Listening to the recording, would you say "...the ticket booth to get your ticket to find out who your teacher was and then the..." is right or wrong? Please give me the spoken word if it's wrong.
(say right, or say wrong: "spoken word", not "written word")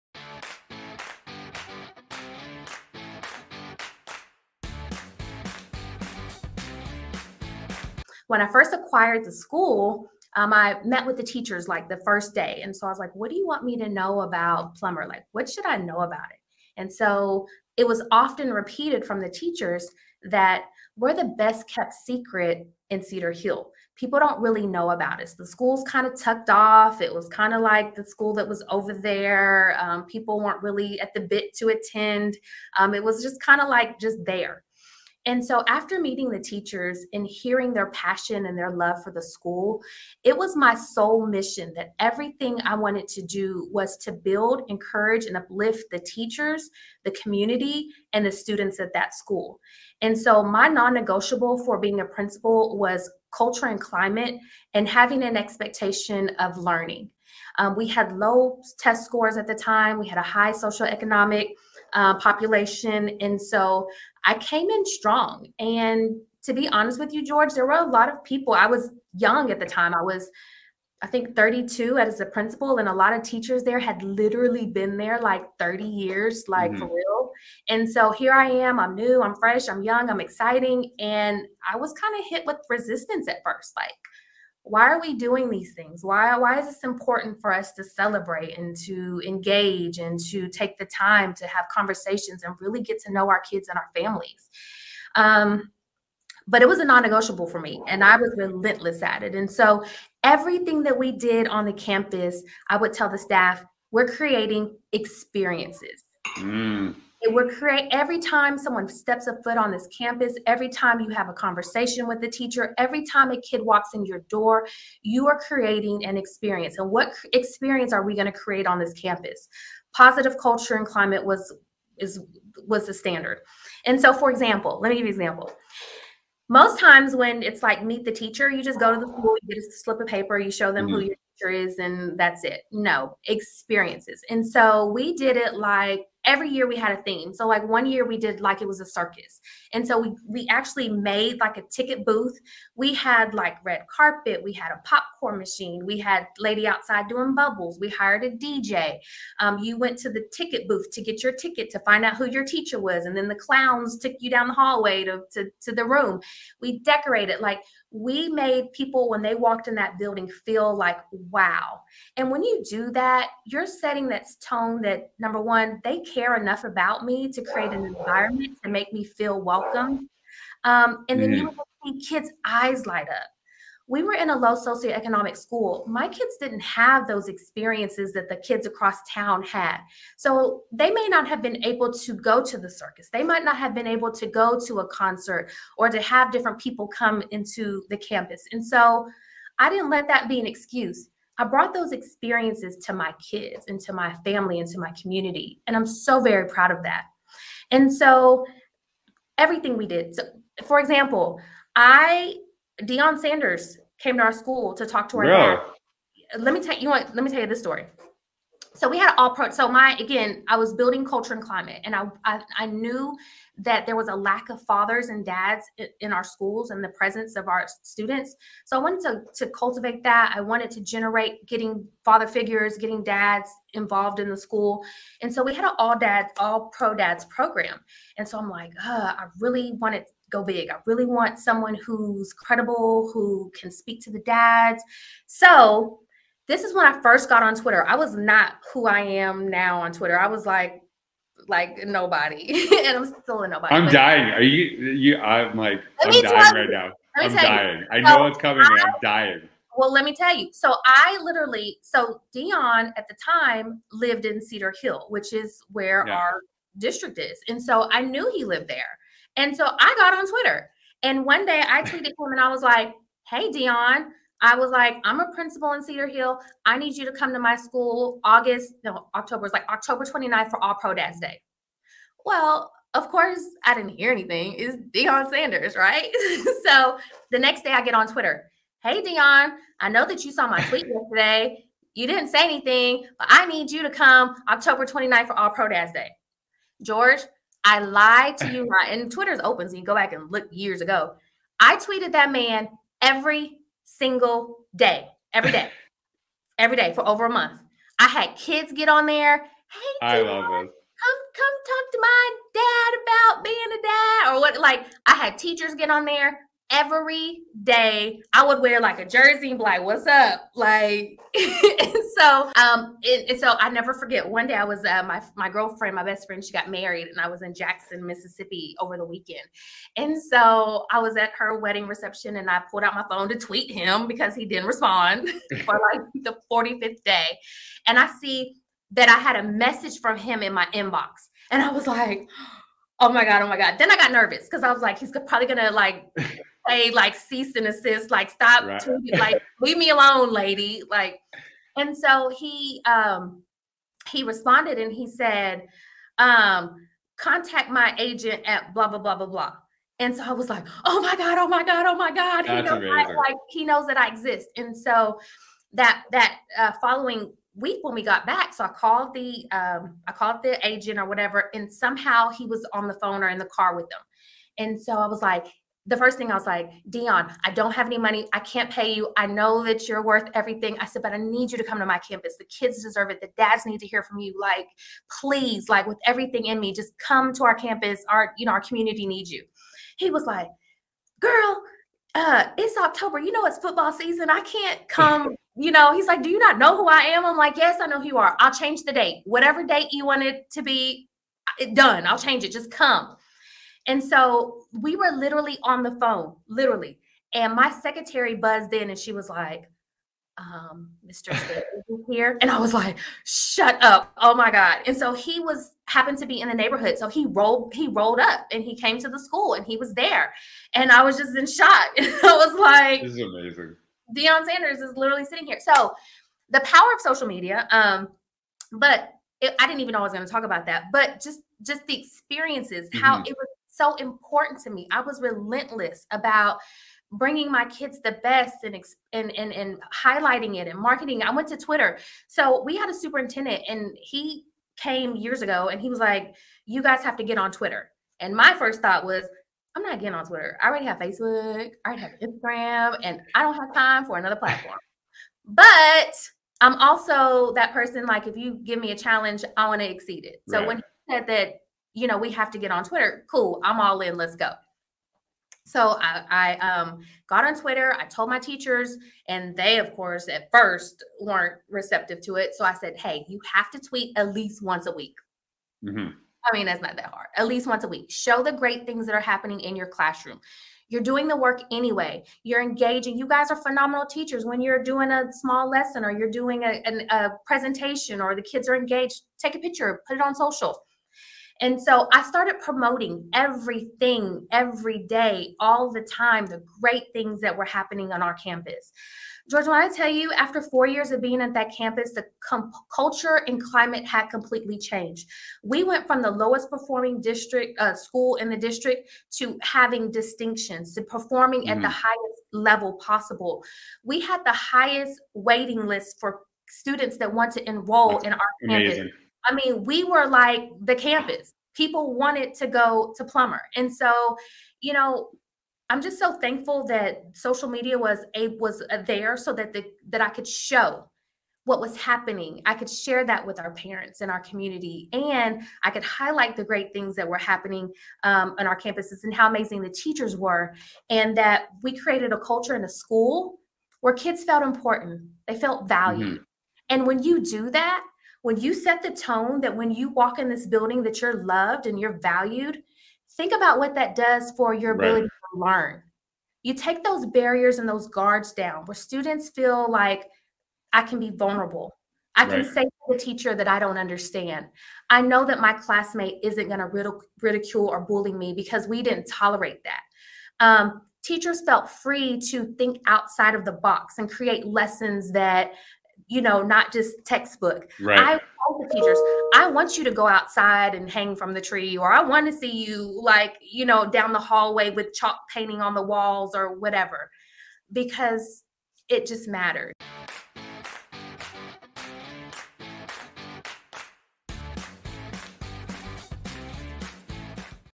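right.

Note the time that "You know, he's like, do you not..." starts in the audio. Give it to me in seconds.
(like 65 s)
385 s.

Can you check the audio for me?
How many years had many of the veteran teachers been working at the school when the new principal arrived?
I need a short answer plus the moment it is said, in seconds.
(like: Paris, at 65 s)
30, at 75 s.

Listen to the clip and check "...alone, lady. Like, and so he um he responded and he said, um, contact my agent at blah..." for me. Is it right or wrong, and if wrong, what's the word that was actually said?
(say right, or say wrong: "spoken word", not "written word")
right.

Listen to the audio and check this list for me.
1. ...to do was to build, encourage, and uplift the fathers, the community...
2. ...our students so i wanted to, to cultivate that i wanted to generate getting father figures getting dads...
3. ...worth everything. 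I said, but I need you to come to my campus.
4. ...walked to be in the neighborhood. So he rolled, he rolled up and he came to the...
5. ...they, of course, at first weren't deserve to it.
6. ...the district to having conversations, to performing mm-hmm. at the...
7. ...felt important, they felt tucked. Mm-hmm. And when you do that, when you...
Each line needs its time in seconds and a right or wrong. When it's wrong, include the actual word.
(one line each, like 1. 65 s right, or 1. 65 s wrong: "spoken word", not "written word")
1. 43 s wrong: "teachers", not "fathers"
2. 217 s right
3. 370 s right
4. 405 s wrong: "happened", not "walked"
5. 459 s wrong: "receptive", not "deserve"
6. 498 s wrong: "distinctions", not "conversations"
7. 534 s wrong: "valued", not "tucked".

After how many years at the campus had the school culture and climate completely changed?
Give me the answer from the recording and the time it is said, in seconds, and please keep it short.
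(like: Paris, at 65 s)
4, at 490 s.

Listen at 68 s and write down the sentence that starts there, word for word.
I was young at the time.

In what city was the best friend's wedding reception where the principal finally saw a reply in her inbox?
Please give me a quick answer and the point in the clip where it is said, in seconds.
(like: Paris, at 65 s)
Jackson, Mississippi, at 317 s.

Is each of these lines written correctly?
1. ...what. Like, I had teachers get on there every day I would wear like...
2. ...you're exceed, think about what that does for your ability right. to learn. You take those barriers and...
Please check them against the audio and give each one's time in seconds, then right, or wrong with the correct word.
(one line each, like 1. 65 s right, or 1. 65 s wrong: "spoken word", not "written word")
1. 304 s right
2. 541 s wrong: "valued", not "exceed".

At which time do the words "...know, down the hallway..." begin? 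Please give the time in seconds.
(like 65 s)
573 s.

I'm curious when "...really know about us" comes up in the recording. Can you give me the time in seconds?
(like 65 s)
24 s.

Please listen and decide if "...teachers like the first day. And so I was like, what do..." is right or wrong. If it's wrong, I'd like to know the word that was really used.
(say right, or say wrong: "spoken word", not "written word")
right.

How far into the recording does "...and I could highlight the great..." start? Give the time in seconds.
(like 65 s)
525 s.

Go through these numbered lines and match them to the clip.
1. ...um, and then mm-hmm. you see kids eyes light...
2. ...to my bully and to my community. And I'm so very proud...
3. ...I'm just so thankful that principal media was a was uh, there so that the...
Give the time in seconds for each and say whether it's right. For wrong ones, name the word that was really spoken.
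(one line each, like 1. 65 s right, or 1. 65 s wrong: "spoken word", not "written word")
1. 170 s right
2. 193 s wrong: "family", not "bully"
3. 515 s wrong: "social", not "principal".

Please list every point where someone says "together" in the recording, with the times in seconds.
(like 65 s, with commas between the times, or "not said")
not said.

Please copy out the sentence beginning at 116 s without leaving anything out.
And what experience are we going to create on this campus?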